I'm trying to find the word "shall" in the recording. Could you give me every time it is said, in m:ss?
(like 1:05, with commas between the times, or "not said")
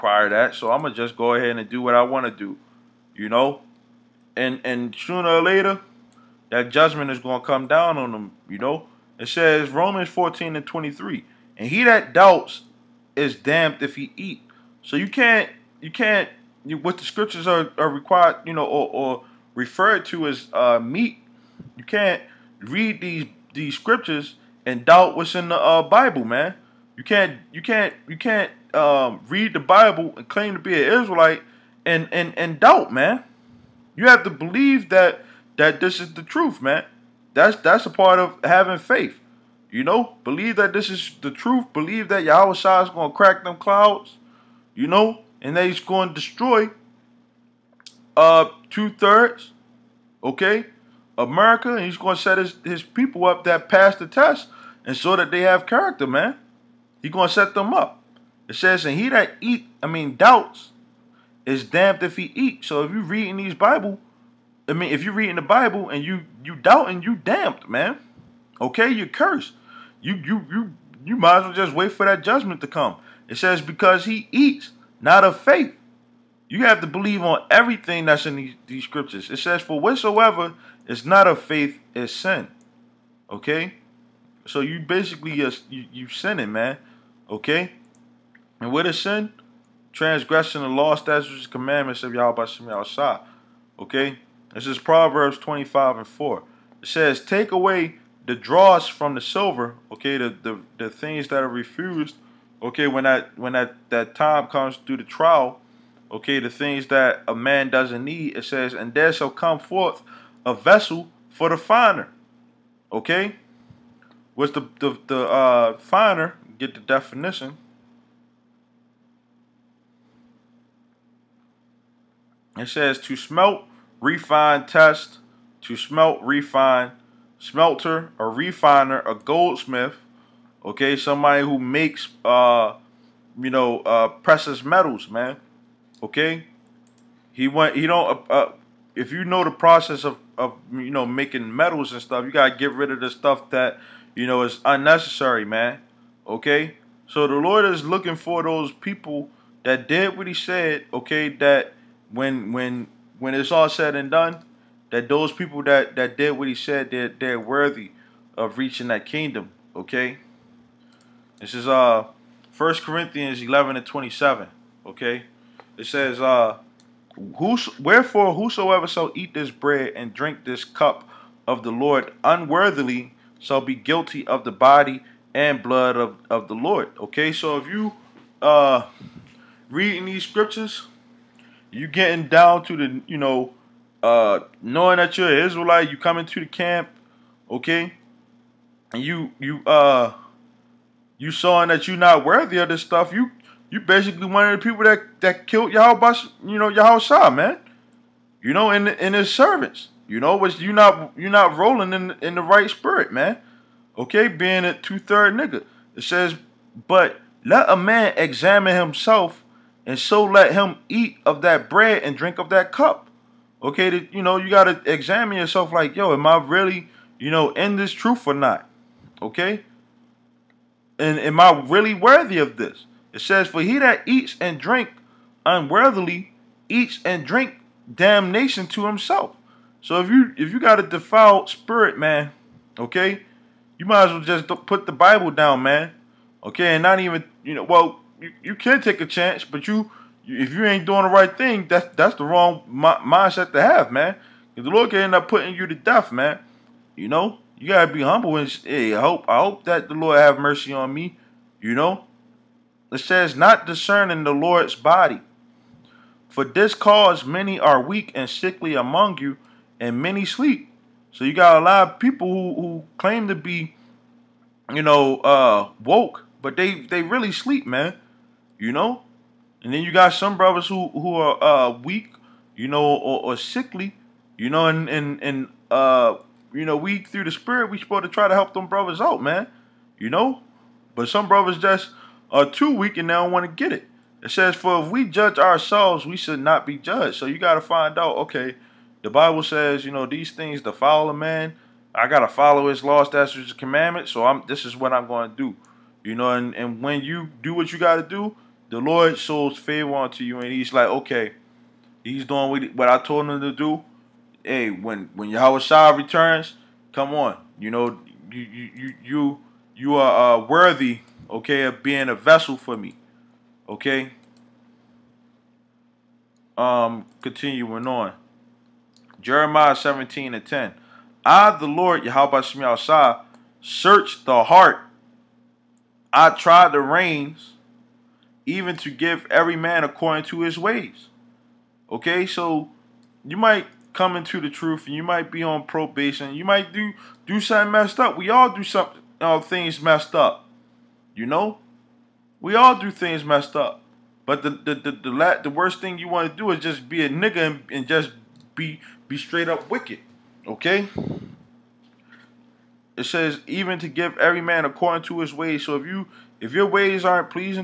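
1:49, 2:48, 2:53.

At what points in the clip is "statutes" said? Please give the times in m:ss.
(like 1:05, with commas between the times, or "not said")
1:30, 4:53.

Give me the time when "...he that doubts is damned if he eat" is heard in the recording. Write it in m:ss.
0:11.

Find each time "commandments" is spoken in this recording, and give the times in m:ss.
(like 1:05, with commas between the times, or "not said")
1:31, 4:53.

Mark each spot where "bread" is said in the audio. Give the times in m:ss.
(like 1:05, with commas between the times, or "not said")
2:49, 3:31.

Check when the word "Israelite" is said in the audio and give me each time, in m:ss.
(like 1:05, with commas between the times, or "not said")
0:31, 3:05.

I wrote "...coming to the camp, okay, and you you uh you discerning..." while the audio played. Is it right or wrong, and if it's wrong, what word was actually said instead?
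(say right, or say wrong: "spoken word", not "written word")
wrong: "showing", not "discerning".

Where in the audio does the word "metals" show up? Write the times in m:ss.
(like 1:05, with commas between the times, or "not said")
2:14, 2:21.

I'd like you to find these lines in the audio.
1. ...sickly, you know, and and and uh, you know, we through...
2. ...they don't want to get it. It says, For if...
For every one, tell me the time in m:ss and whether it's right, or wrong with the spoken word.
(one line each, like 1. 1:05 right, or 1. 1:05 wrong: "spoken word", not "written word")
1. 4:33 right
2. 4:43 right.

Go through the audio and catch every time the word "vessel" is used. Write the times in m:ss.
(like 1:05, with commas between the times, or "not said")
1:50, 5:12.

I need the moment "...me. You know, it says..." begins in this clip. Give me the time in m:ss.
4:10.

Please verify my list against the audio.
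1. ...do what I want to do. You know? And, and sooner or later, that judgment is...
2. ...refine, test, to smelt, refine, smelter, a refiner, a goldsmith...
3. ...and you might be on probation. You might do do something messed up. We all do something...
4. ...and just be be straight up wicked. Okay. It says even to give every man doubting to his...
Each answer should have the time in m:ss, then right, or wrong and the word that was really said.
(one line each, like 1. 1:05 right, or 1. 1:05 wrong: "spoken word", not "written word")
1. 0:01 right
2. 2:04 right
3. 5:34 right
4. 5:47 wrong: "according", not "doubting".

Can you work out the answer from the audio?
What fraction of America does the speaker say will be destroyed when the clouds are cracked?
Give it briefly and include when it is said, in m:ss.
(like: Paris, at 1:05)
two thirds, at 0:48.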